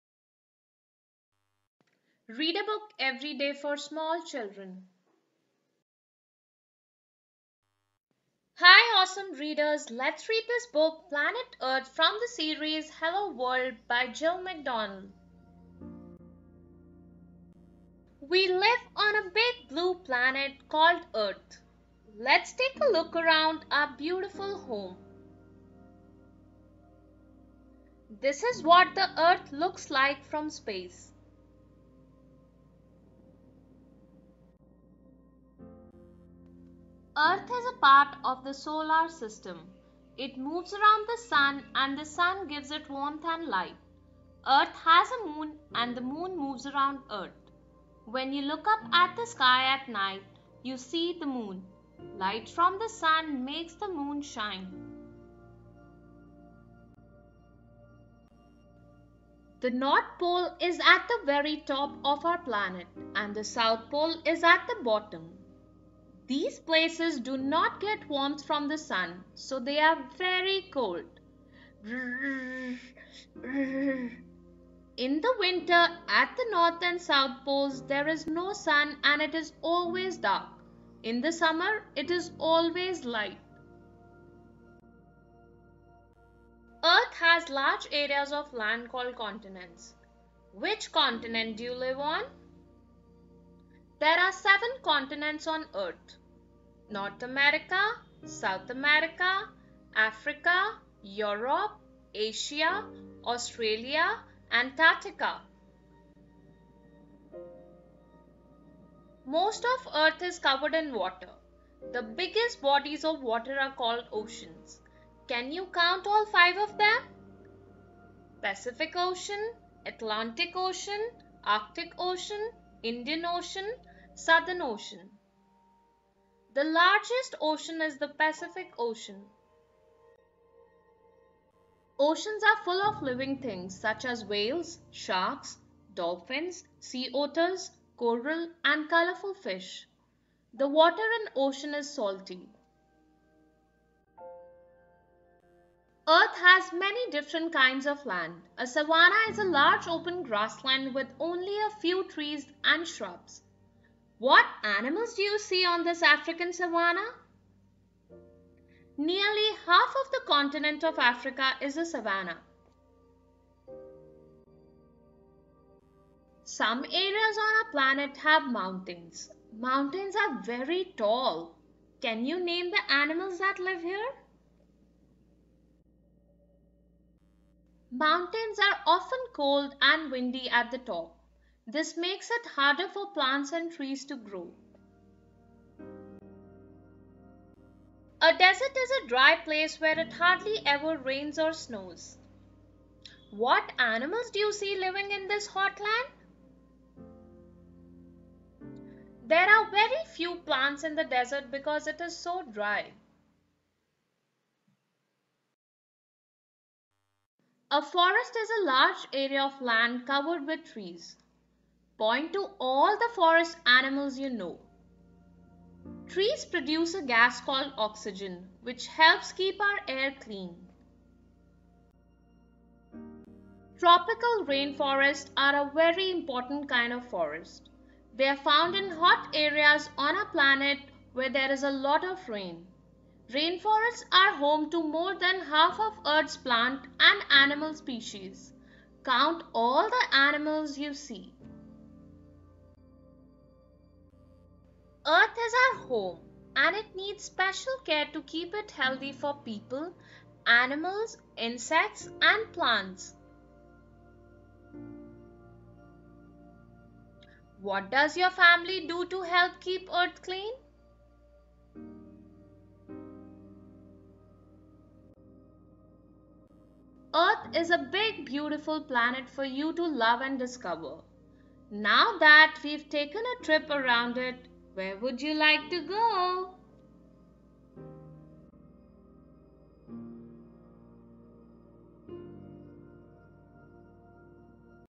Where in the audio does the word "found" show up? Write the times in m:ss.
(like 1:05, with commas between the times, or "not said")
3:48.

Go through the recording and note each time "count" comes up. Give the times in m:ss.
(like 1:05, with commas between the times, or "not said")
1:55, 3:59.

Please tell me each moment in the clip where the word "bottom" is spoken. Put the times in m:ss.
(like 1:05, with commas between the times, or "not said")
1:04.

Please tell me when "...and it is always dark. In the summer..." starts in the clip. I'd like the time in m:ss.
1:19.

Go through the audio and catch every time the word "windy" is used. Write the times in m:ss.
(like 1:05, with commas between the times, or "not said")
3:00.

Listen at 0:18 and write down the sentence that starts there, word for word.
We live on a big blue planet called Earth.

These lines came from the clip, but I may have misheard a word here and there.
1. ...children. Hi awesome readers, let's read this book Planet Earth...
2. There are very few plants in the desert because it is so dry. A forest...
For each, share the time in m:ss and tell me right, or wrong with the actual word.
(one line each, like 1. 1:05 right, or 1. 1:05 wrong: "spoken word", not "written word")
1. 0:04 right
2. 3:19 right.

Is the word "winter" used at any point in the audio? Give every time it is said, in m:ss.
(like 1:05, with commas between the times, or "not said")
1:15.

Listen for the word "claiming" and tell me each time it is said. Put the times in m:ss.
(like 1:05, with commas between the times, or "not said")
not said.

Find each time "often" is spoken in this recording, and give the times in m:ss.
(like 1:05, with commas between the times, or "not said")
2:58.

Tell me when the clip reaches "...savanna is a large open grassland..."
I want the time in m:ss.
2:28.